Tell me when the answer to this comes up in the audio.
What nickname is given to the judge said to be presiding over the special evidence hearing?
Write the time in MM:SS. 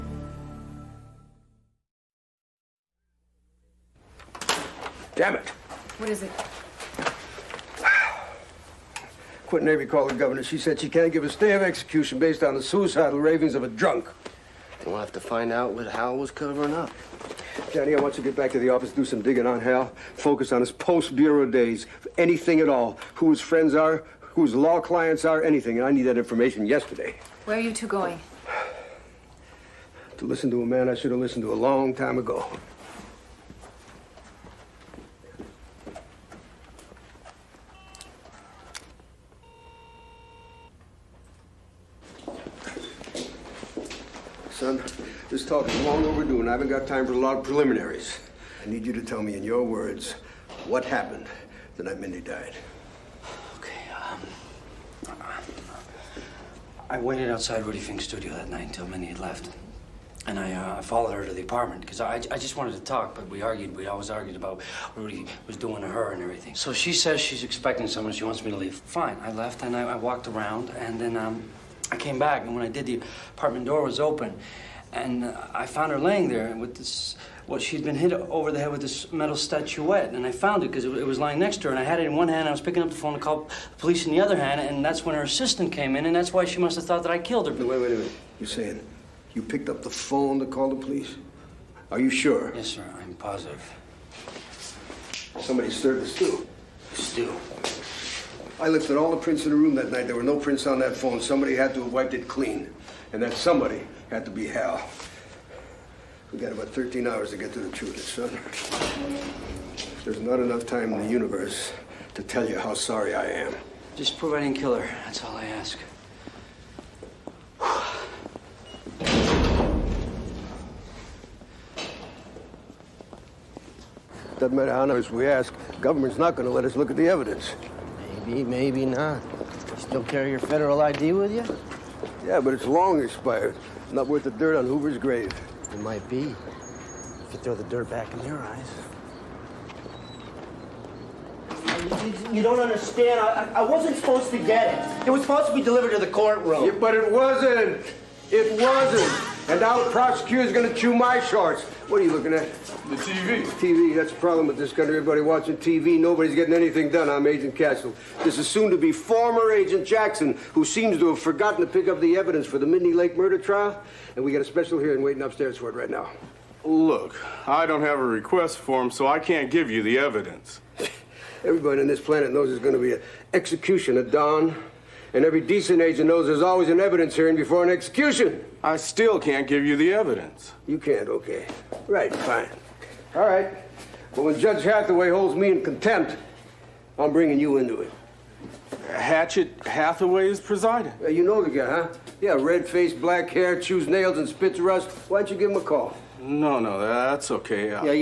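03:08.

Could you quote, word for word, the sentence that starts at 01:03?
We always argued about what Rudy was doing to her and everything.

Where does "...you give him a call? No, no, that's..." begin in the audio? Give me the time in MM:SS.
03:15.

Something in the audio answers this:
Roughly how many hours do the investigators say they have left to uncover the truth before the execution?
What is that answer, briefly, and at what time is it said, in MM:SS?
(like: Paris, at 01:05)
13, at 01:46.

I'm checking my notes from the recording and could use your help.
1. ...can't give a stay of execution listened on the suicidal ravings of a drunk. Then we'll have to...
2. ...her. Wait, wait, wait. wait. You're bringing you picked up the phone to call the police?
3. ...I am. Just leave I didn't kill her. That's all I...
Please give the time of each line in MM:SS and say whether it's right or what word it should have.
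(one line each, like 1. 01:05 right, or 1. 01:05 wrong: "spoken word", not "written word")
1. 00:10 wrong: "based", not "listened"
2. 01:27 wrong: "saying", not "bringing"
3. 01:53 wrong: "prove", not "leave".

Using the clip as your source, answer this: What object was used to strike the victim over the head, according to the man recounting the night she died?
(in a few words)
Metal statuette.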